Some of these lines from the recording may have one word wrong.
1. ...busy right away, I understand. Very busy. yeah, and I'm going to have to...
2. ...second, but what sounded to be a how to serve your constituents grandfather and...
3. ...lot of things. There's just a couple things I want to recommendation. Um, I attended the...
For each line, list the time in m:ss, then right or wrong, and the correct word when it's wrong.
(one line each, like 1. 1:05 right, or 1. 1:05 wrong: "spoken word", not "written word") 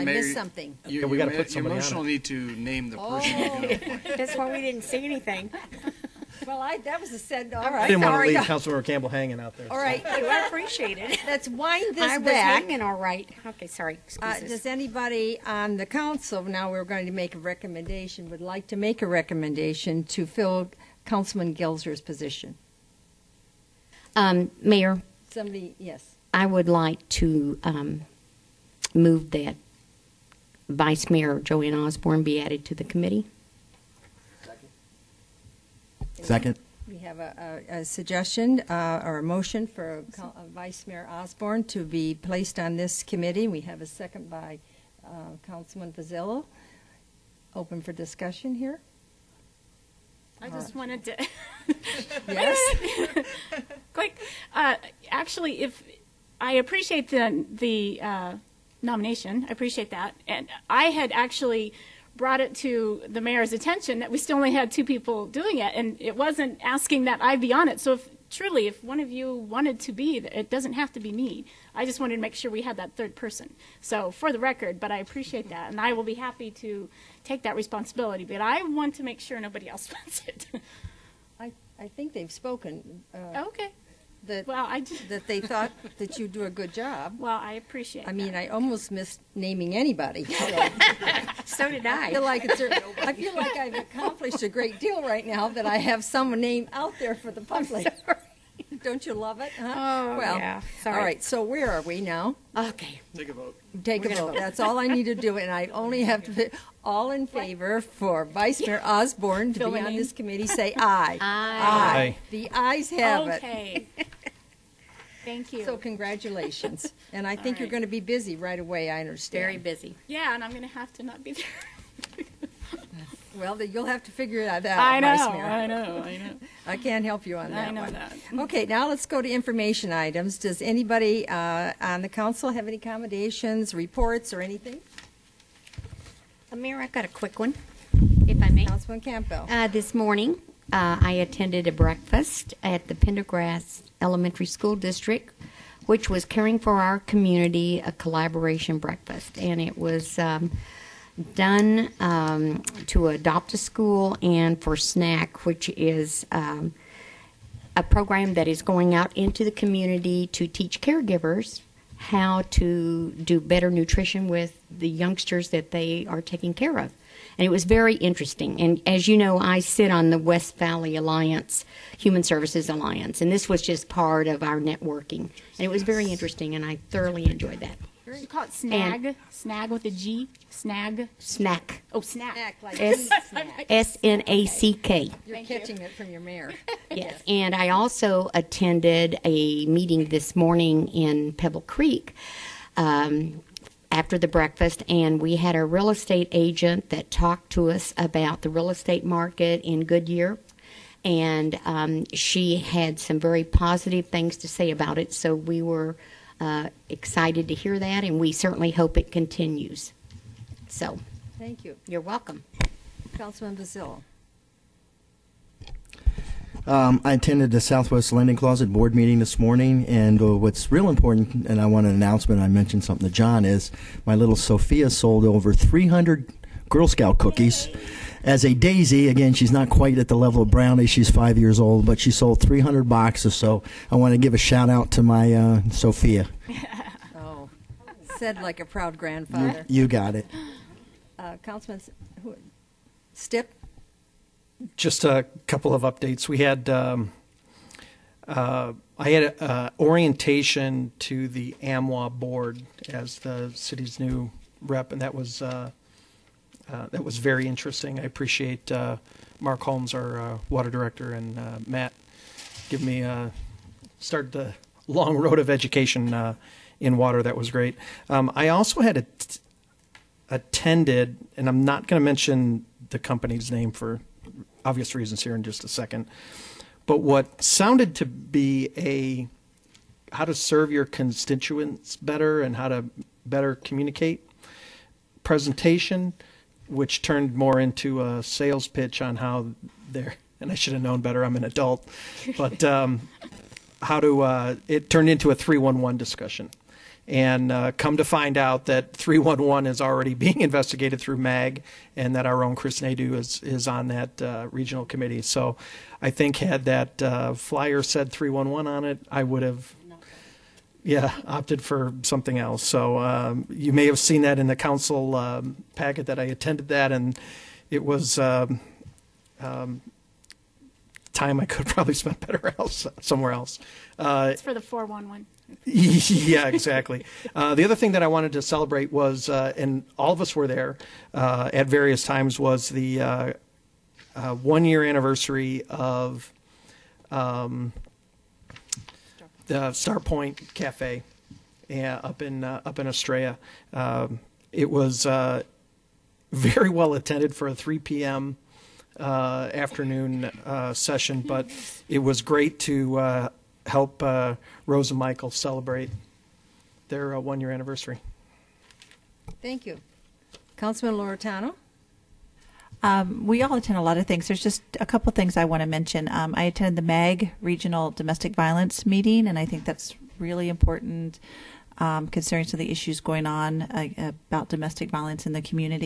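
1. 1:57 right
2. 4:35 wrong: "better", not "grandfather"
3. 6:03 wrong: "mention", not "recommendation".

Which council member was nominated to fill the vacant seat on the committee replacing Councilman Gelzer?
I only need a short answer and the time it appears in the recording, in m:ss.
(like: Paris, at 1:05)
Joanne Osborne, at 0:31.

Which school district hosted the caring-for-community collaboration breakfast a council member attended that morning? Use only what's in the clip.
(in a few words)
Pendergast Elementary School District.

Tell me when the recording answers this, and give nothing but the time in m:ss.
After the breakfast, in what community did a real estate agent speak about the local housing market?
3:11.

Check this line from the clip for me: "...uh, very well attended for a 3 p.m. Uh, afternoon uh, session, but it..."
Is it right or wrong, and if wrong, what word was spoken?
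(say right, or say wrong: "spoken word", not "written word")
right.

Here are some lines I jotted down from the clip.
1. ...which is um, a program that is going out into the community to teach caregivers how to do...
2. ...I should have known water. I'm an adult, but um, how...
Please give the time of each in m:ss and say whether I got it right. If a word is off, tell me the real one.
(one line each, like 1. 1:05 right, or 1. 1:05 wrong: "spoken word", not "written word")
1. 2:35 right
2. 4:50 wrong: "better", not "water".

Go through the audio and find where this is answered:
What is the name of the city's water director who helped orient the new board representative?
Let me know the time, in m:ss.
4:19.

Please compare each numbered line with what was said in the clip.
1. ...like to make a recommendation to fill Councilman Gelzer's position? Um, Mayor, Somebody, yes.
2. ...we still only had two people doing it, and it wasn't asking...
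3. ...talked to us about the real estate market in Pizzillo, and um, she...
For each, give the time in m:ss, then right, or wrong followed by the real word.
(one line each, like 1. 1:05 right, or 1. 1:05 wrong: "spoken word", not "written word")
1. 0:18 right
2. 1:04 right
3. 3:17 wrong: "Goodyear", not "Pizzillo".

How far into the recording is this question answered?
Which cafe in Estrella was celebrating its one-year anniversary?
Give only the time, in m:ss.
5:39.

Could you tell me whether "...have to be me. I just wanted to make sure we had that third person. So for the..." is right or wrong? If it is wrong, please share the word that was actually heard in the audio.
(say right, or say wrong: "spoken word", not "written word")
right.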